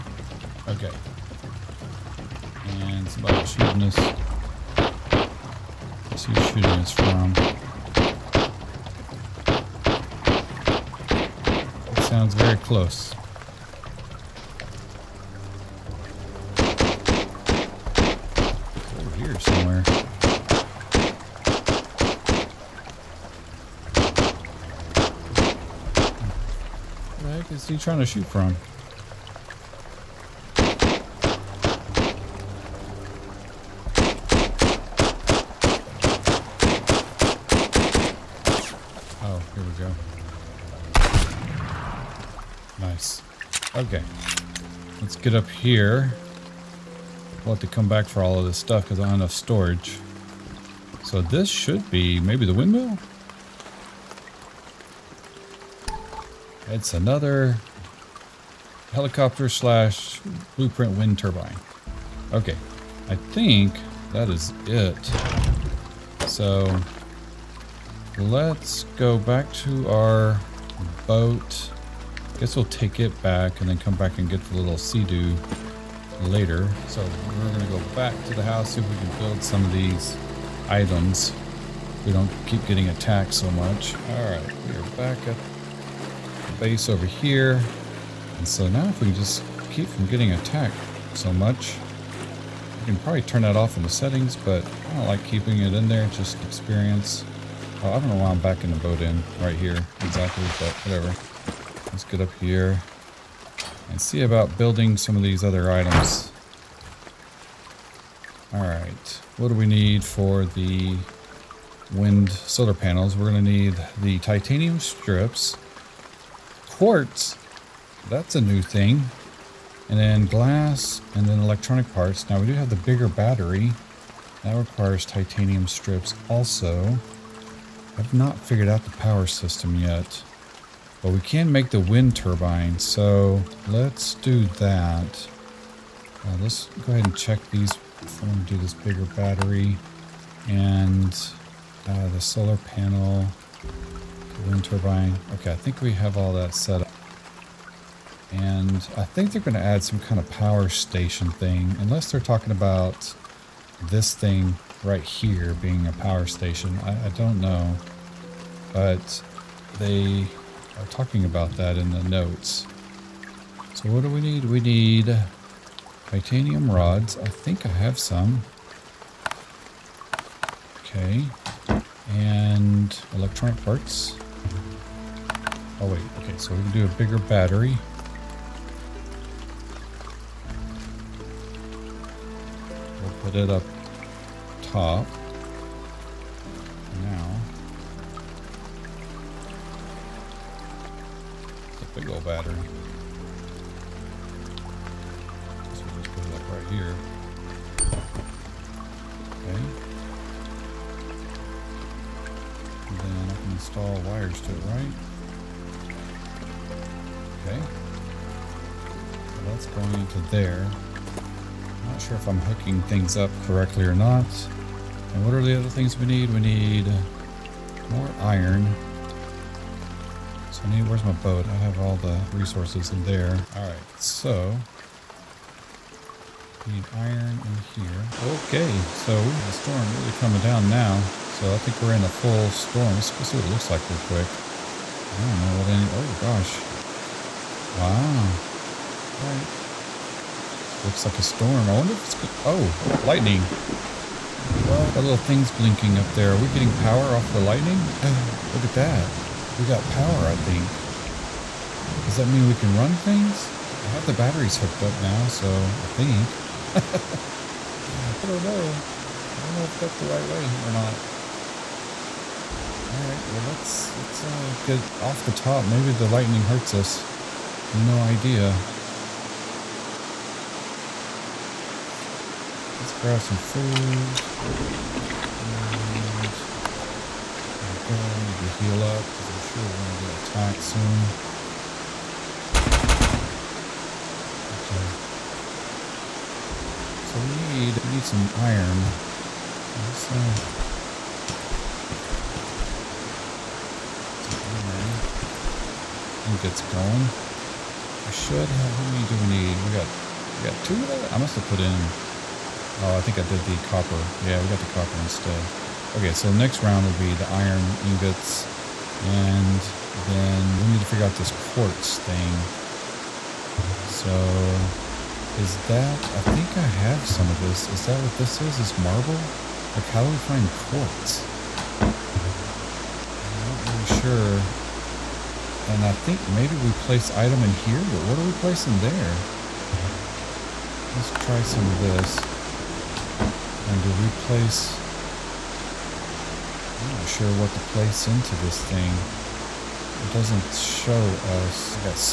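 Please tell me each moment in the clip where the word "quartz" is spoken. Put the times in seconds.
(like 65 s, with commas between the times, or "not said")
116 s, 311 s, 320 s.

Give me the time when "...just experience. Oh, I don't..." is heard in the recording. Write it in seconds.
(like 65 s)
96 s.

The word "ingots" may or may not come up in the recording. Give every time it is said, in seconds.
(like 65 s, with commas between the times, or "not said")
307 s.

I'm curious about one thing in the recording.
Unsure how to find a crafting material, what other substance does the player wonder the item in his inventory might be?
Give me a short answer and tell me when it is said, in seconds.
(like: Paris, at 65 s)
marble, at 318 s.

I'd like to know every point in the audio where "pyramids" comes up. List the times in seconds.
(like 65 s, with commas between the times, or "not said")
not said.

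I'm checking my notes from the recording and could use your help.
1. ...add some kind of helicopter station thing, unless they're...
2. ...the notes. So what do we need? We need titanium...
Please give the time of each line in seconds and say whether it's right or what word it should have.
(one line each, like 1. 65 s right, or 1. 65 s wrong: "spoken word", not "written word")
1. 149 s wrong: "power", not "helicopter"
2. 161 s right.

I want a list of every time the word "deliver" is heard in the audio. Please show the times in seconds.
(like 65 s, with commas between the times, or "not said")
not said.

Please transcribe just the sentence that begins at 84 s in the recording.
Alright, we are back at the base over here.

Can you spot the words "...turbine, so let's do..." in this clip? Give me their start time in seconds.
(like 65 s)
132 s.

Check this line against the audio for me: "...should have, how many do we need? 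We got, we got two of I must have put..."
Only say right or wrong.
right.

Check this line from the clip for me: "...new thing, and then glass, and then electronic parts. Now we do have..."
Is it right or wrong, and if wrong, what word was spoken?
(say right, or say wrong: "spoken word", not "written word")
right.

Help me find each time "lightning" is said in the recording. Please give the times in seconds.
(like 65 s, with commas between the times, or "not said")
243 s, 247 s, 266 s.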